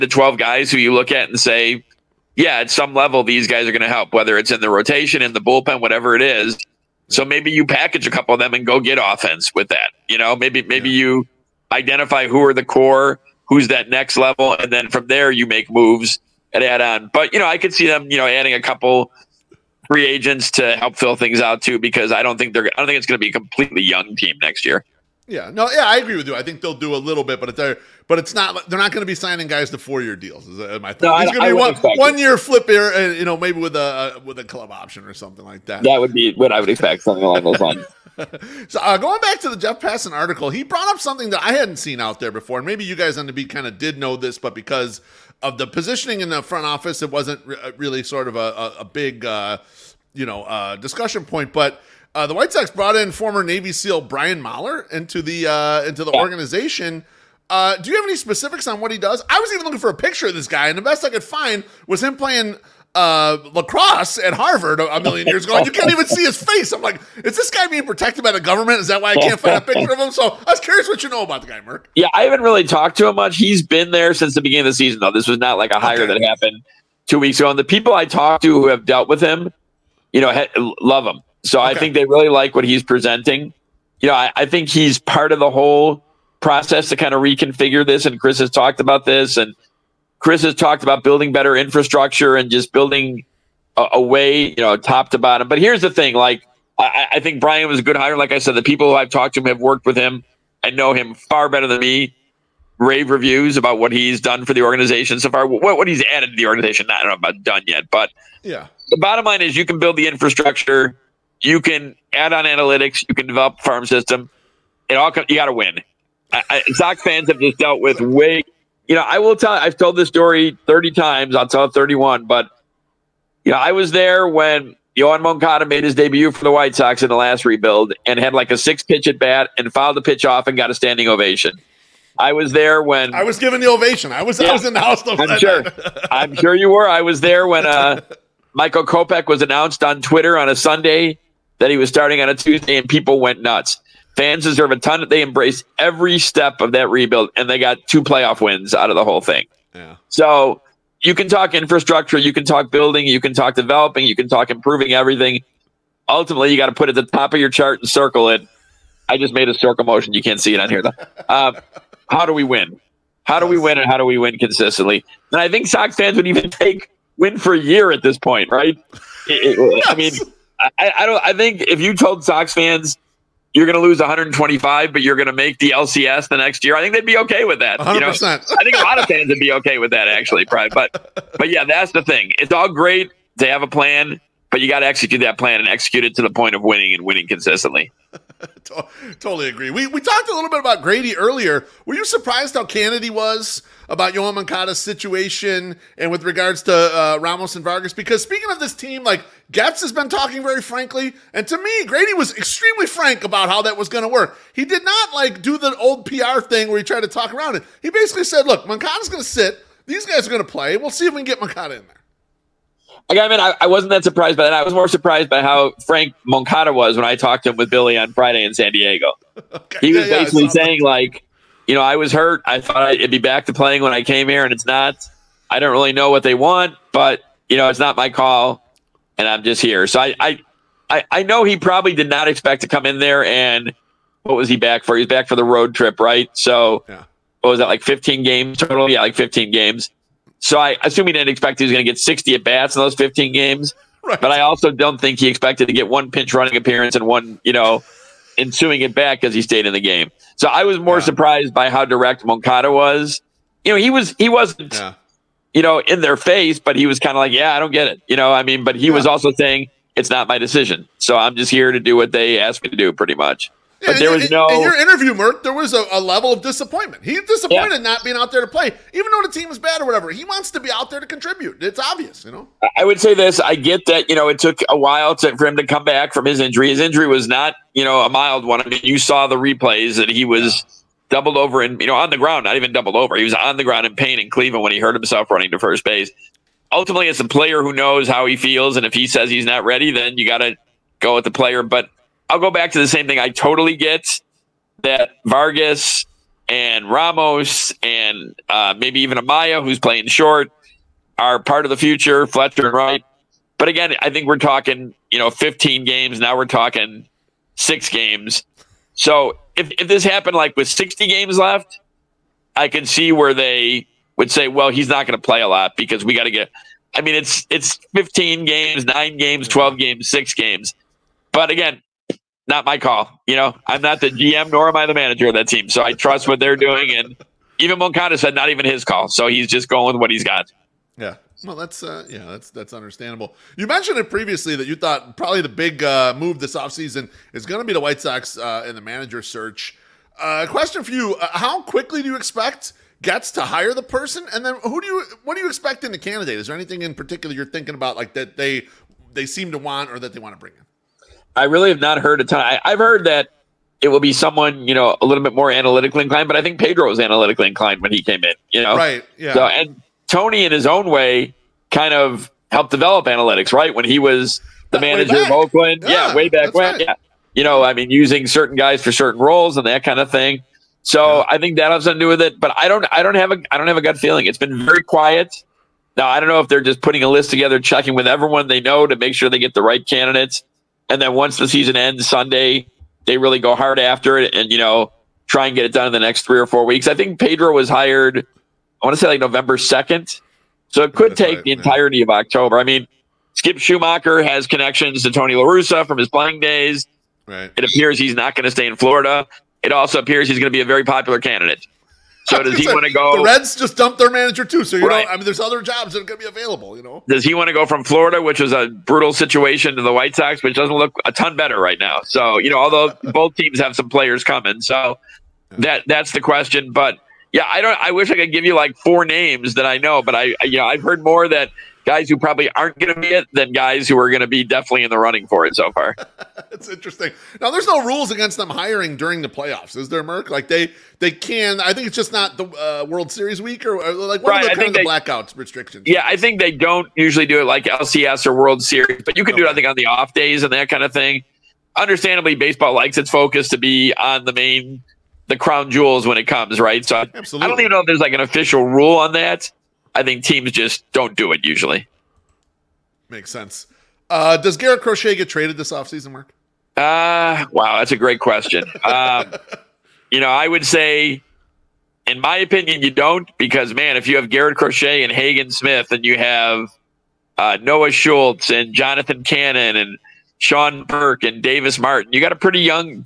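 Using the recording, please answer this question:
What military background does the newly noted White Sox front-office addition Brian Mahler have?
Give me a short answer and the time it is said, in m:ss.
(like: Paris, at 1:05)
Navy SEAL, at 0:53.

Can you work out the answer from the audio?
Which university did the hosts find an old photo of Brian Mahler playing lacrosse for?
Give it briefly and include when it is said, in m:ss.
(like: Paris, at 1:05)
Harvard, at 1:04.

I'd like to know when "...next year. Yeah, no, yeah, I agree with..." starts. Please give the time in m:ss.
0:24.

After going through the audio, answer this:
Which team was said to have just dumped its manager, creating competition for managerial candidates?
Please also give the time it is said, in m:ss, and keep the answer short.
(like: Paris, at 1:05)
Reds, at 6:43.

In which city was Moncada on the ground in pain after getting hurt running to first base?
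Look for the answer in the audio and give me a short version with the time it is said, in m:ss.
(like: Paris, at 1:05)
Cleveland, at 4:44.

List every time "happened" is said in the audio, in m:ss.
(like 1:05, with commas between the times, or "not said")
1:16, 5:10.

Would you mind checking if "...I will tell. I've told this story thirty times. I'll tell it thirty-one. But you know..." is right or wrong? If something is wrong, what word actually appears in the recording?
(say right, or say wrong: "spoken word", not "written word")
right.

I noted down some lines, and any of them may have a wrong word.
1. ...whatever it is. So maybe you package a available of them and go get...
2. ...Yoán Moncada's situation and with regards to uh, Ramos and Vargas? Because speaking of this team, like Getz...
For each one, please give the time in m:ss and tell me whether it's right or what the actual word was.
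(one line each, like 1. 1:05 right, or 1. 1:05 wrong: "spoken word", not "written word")
1. 0:05 wrong: "couple", not "available"
2. 3:14 right.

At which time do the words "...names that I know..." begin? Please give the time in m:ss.
6:59.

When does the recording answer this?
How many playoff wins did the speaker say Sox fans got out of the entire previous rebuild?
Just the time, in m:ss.
2:27.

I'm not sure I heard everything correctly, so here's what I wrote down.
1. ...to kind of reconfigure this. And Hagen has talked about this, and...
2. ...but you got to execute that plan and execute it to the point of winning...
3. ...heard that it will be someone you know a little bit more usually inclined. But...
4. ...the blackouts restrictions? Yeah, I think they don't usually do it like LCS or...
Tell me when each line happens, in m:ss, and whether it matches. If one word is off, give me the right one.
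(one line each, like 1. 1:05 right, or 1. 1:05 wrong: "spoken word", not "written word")
1. 1:26 wrong: "Chris", not "Hagen"
2. 3:04 right
3. 5:52 wrong: "analytically", not "usually"
4. 7:14 right.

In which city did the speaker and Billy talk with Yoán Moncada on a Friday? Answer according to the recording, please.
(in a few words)
San Diego.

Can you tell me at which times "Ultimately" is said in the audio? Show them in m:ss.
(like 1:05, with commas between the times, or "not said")
2:36, 4:46.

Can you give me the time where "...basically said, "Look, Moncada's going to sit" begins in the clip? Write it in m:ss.
3:27.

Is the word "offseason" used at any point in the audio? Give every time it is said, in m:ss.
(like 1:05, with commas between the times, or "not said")
5:36, 7:35.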